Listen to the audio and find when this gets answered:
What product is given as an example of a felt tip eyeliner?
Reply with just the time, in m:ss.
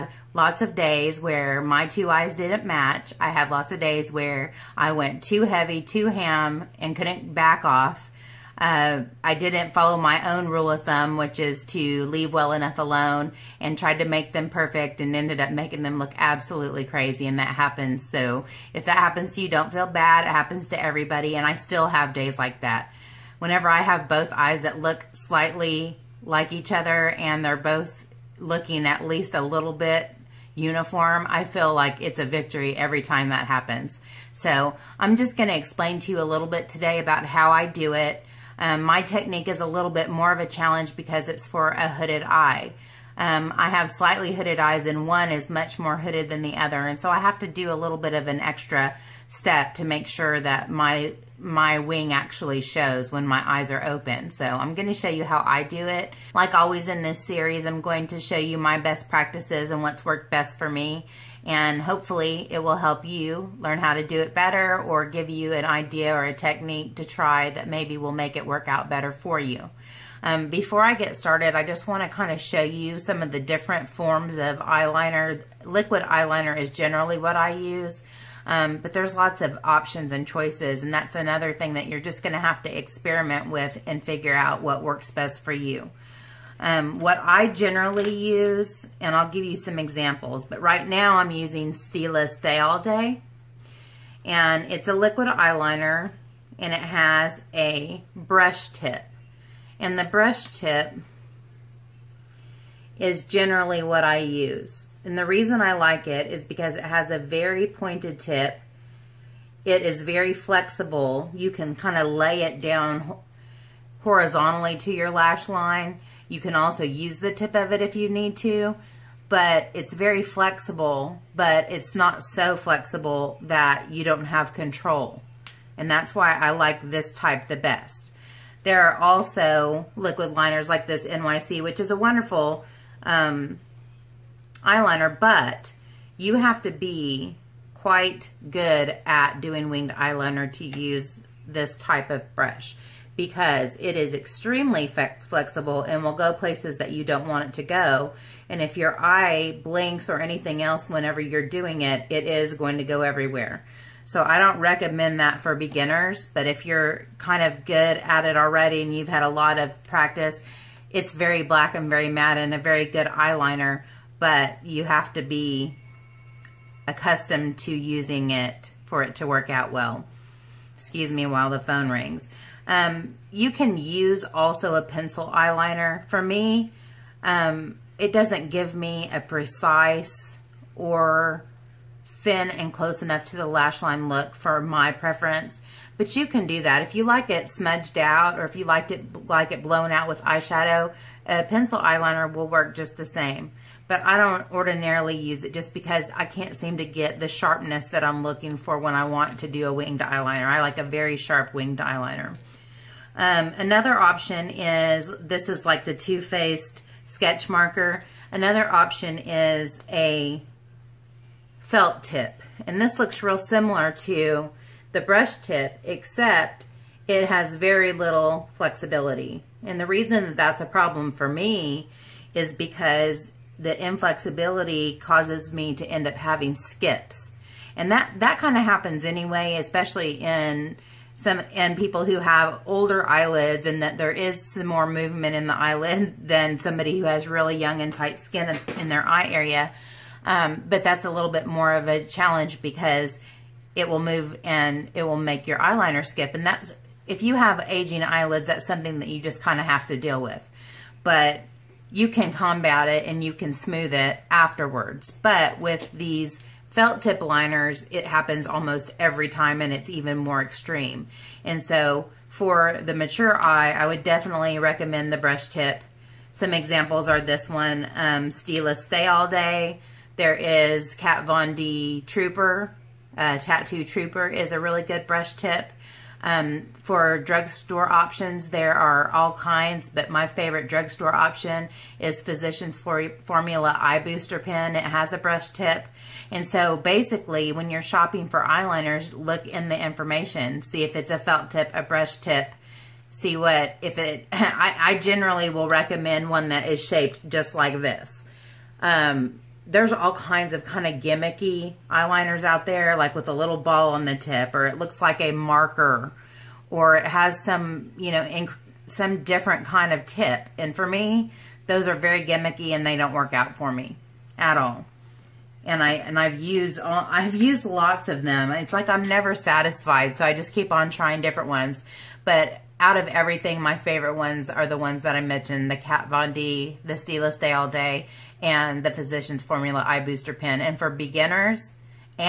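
3:25.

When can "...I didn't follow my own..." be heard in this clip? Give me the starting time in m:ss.
0:09.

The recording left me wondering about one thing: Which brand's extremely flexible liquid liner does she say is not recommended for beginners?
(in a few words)
NYC.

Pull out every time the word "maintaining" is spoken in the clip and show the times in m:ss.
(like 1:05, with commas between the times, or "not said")
not said.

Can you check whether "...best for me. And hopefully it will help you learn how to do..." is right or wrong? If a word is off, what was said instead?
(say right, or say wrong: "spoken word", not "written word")
right.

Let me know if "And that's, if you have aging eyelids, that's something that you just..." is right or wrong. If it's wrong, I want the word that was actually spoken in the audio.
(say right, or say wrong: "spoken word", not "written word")
right.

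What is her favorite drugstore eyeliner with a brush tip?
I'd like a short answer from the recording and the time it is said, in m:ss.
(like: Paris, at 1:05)
Physicians Formula Eye Booster Pen, at 4:42.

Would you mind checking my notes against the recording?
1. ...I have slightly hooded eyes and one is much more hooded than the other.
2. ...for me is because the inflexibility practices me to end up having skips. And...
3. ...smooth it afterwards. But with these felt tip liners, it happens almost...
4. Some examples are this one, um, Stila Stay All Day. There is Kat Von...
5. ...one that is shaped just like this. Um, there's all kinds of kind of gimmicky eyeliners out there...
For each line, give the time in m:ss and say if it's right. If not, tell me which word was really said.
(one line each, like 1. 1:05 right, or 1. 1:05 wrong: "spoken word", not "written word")
1. 0:43 right
2. 3:41 wrong: "causes", not "practices"
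3. 4:13 right
4. 4:26 right
5. 4:56 right.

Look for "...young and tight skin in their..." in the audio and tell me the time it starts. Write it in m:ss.
3:57.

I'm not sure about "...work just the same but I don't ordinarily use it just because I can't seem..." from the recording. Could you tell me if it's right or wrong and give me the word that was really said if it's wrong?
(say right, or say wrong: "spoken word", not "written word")
right.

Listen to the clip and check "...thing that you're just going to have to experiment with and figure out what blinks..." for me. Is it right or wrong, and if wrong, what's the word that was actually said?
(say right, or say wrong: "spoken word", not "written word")
wrong: "works", not "blinks".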